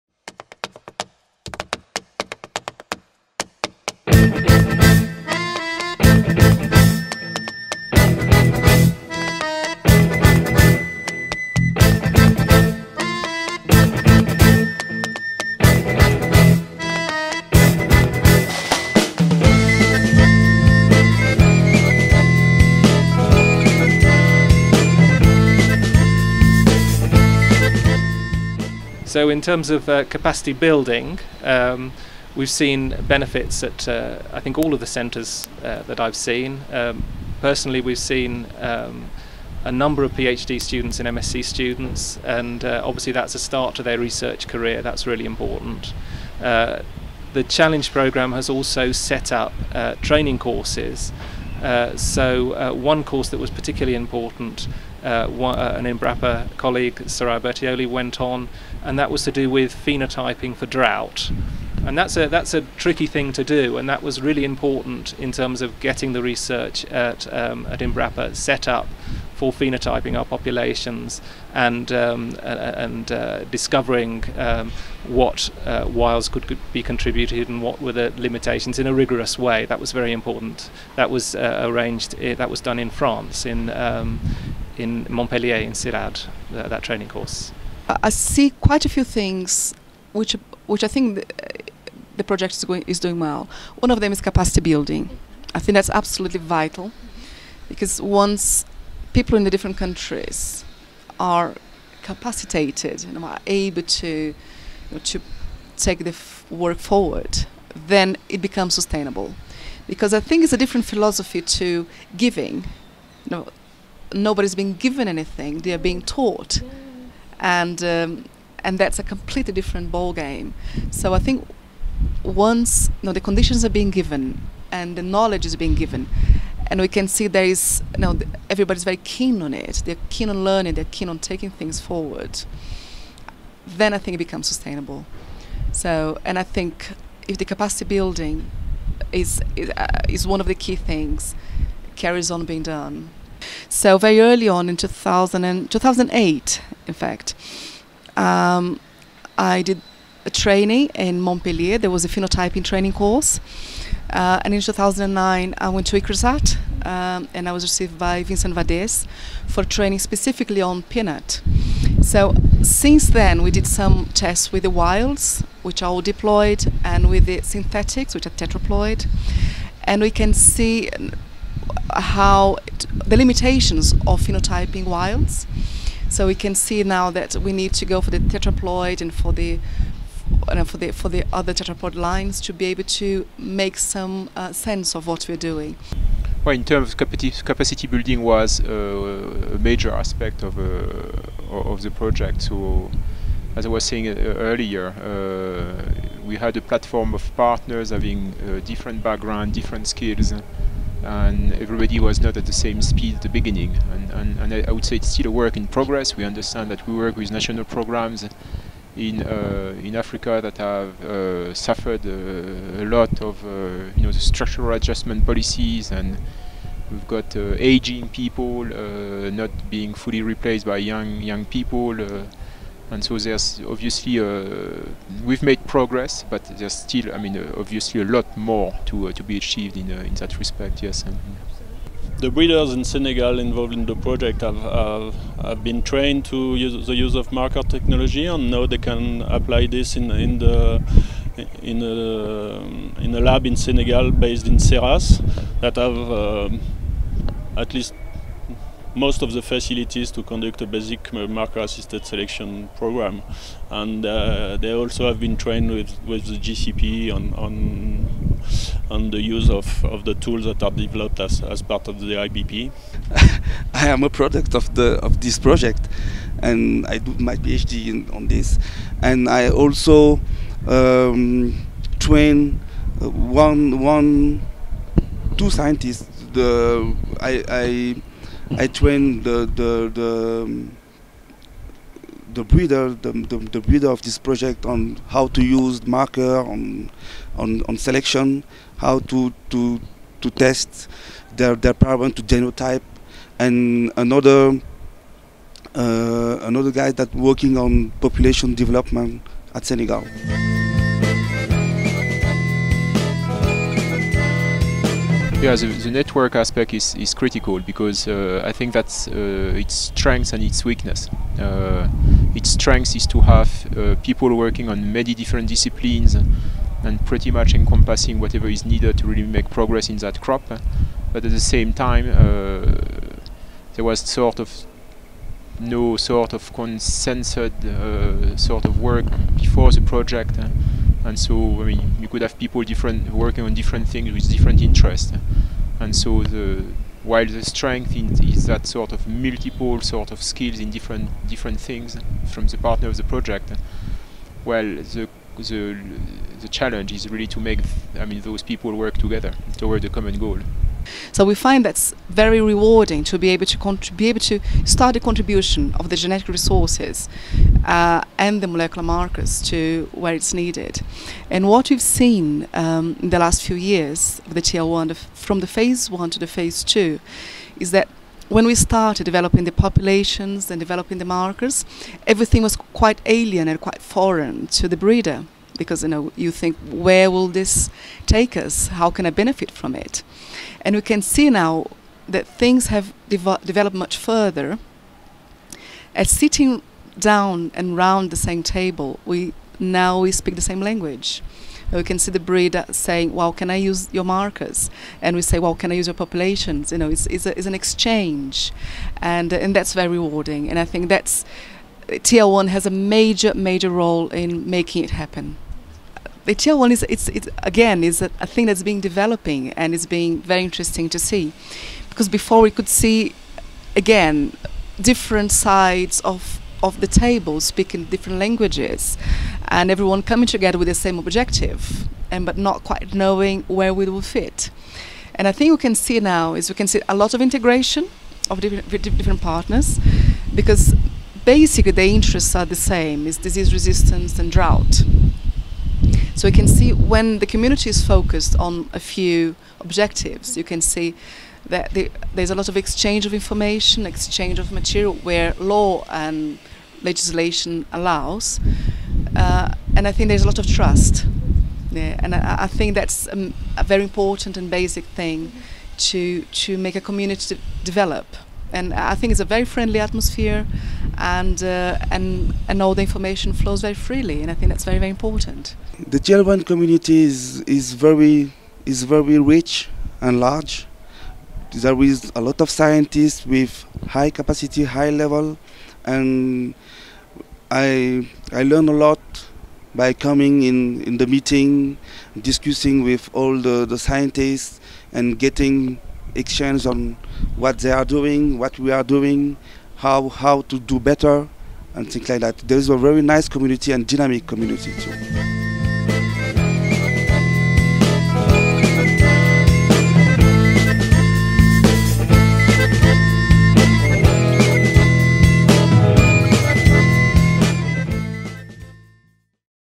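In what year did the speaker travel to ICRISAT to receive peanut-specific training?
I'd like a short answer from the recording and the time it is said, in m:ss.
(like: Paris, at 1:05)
2009, at 2:34.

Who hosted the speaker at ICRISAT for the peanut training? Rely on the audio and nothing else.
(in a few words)
Vincent Vadez.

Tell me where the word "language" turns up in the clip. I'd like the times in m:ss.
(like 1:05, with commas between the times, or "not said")
6:30, 6:58.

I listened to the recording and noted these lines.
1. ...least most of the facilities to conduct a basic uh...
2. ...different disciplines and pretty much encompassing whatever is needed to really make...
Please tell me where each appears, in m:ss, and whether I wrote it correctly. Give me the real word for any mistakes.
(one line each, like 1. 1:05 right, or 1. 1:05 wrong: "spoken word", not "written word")
1. 4:07 right
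2. 5:15 right.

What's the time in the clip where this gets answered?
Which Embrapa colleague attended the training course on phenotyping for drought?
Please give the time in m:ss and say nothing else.
0:57.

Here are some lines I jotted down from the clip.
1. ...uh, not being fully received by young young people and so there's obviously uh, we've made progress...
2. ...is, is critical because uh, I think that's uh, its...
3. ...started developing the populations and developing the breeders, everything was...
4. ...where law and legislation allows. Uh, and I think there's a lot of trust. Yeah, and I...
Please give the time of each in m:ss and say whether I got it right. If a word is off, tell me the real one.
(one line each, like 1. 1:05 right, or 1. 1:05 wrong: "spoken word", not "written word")
1. 3:38 wrong: "replaced", not "received"
2. 5:06 right
3. 6:08 wrong: "markers", not "breeders"
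4. 7:25 right.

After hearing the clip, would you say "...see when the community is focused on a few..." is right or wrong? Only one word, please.
right.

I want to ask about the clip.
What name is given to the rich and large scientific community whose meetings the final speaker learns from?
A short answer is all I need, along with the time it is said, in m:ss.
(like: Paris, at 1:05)
Gelban, at 7:45.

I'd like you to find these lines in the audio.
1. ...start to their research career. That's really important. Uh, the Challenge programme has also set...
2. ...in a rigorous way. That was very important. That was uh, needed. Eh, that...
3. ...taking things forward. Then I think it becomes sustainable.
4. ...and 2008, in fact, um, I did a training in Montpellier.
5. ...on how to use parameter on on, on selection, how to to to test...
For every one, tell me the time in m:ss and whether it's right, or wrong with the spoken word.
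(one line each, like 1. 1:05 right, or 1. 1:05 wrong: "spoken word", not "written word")
1. 0:43 right
2. 1:18 wrong: "arranged", not "needed"
3. 2:11 right
4. 2:25 right
5. 4:44 wrong: "marker", not "parameter".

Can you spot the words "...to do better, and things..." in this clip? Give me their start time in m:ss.
8:10.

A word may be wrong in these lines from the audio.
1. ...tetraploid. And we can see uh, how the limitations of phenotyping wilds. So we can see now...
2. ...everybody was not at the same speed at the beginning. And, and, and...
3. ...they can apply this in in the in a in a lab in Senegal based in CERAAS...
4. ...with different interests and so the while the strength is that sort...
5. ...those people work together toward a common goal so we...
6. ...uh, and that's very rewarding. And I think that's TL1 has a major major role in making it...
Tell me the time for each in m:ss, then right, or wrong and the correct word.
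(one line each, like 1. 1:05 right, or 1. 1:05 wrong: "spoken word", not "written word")
1. 2:48 right
2. 3:21 right
3. 3:58 right
4. 5:34 right
5. 5:48 right
6. 6:39 right.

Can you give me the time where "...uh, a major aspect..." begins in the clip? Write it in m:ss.
3:08.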